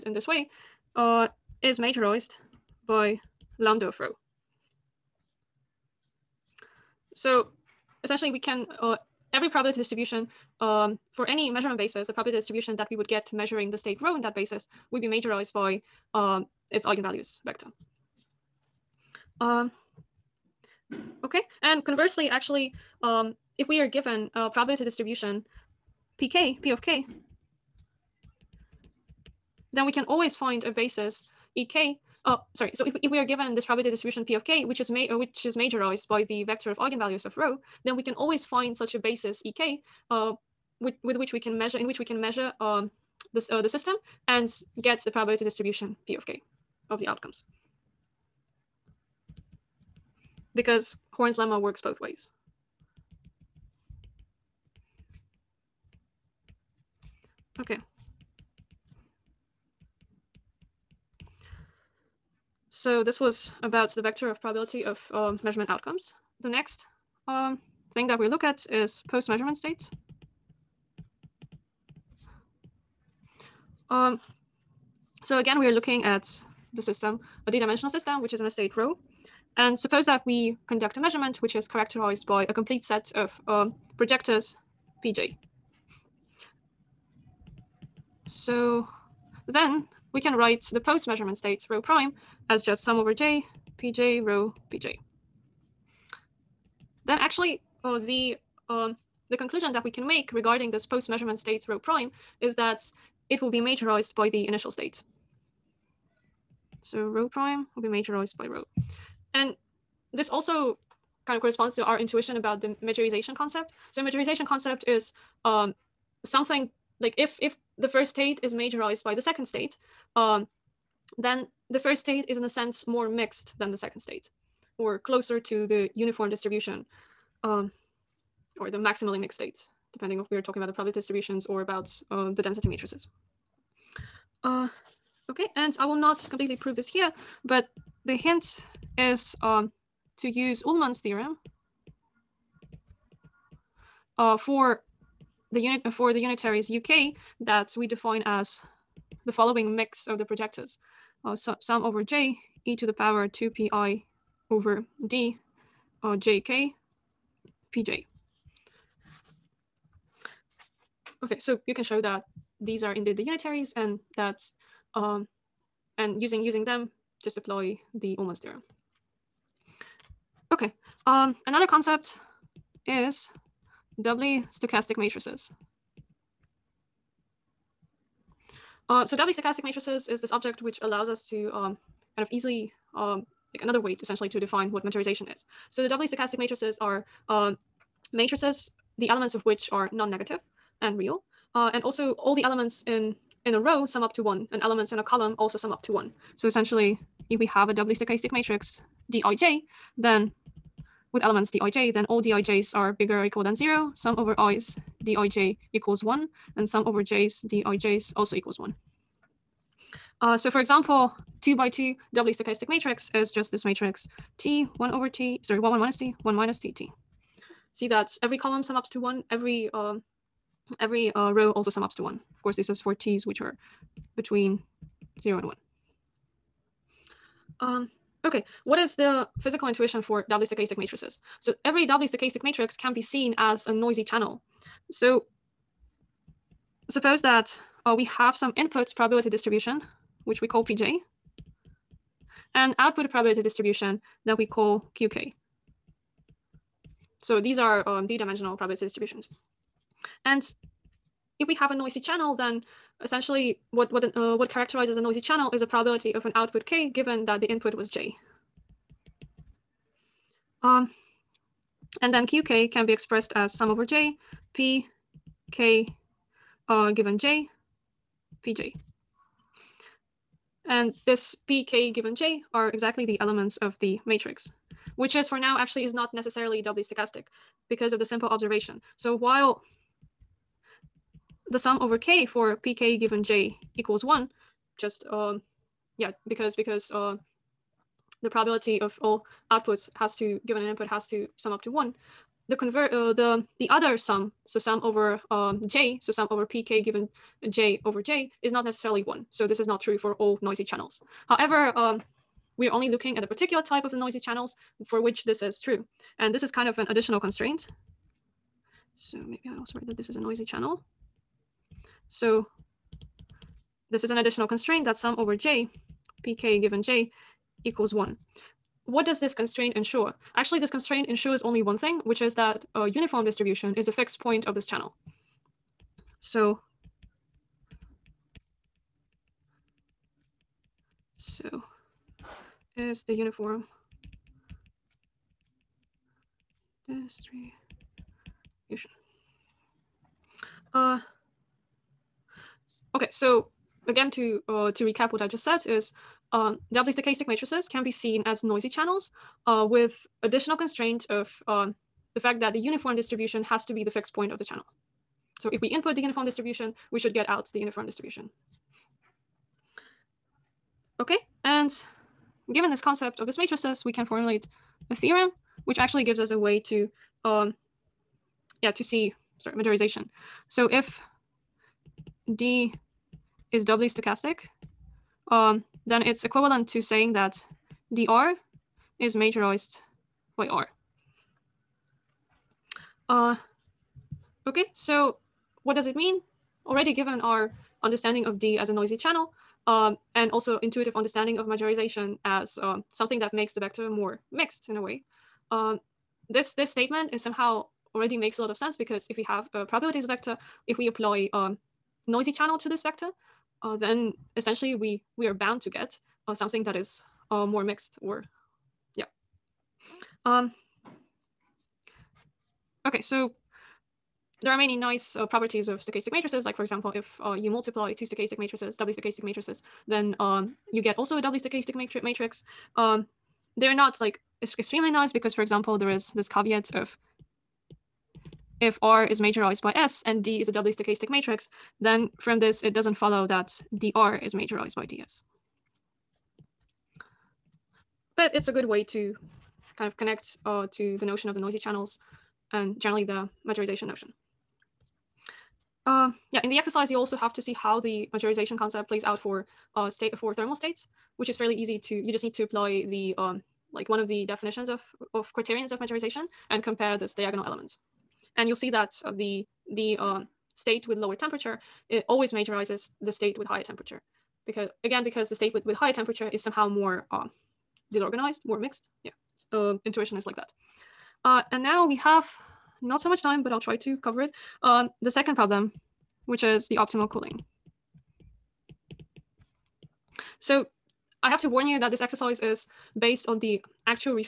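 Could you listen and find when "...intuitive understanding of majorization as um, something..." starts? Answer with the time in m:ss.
6:30.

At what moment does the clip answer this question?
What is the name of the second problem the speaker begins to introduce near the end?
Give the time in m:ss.
7:56.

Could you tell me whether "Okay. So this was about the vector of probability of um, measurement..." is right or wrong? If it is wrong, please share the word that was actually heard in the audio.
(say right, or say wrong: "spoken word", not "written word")
right.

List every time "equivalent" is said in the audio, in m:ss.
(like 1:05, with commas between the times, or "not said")
6:16.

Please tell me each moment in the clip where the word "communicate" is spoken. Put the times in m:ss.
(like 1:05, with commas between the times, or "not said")
not said.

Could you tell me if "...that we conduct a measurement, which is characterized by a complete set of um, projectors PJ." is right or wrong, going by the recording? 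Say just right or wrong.
right.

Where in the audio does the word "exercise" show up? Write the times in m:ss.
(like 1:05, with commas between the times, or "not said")
7:26, 8:01.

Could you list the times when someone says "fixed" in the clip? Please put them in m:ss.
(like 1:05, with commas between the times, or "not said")
5:23, 5:53.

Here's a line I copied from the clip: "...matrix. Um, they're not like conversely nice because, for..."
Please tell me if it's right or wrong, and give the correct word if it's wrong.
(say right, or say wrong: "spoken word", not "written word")
wrong: "extremely", not "conversely".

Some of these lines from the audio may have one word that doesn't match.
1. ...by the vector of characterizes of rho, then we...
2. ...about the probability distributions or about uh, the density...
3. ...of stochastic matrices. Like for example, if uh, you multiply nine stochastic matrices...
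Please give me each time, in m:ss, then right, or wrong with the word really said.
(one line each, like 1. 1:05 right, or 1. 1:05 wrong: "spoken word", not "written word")
1. 0:36 wrong: "eigenvalues", not "characterizes"
2. 2:10 right
3. 6:55 wrong: "two", not "nine".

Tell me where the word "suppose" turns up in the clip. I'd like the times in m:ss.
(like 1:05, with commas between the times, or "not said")
1:19, 3:56.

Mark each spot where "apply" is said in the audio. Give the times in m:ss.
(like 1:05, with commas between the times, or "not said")
6:40, 7:32.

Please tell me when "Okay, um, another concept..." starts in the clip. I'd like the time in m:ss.
2:50.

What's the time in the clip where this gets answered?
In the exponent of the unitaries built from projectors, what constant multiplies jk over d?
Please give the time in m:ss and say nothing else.
2:33.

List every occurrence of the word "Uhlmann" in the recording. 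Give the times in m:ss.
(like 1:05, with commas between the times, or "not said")
2:20, 2:48.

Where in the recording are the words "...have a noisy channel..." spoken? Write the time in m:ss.
4:11.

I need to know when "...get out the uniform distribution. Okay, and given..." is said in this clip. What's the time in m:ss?
5:57.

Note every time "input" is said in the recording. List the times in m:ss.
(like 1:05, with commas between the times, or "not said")
3:58, 4:17, 4:50, 5:55.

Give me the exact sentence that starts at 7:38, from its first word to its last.
And you'll see that uh, the, the um, state with lower temperature, it always majorizes the state with higher temperature.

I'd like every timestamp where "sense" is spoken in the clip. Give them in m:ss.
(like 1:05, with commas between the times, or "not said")
2:02, 6:38.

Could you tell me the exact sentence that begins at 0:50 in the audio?
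Because Horn's lemma works both ways.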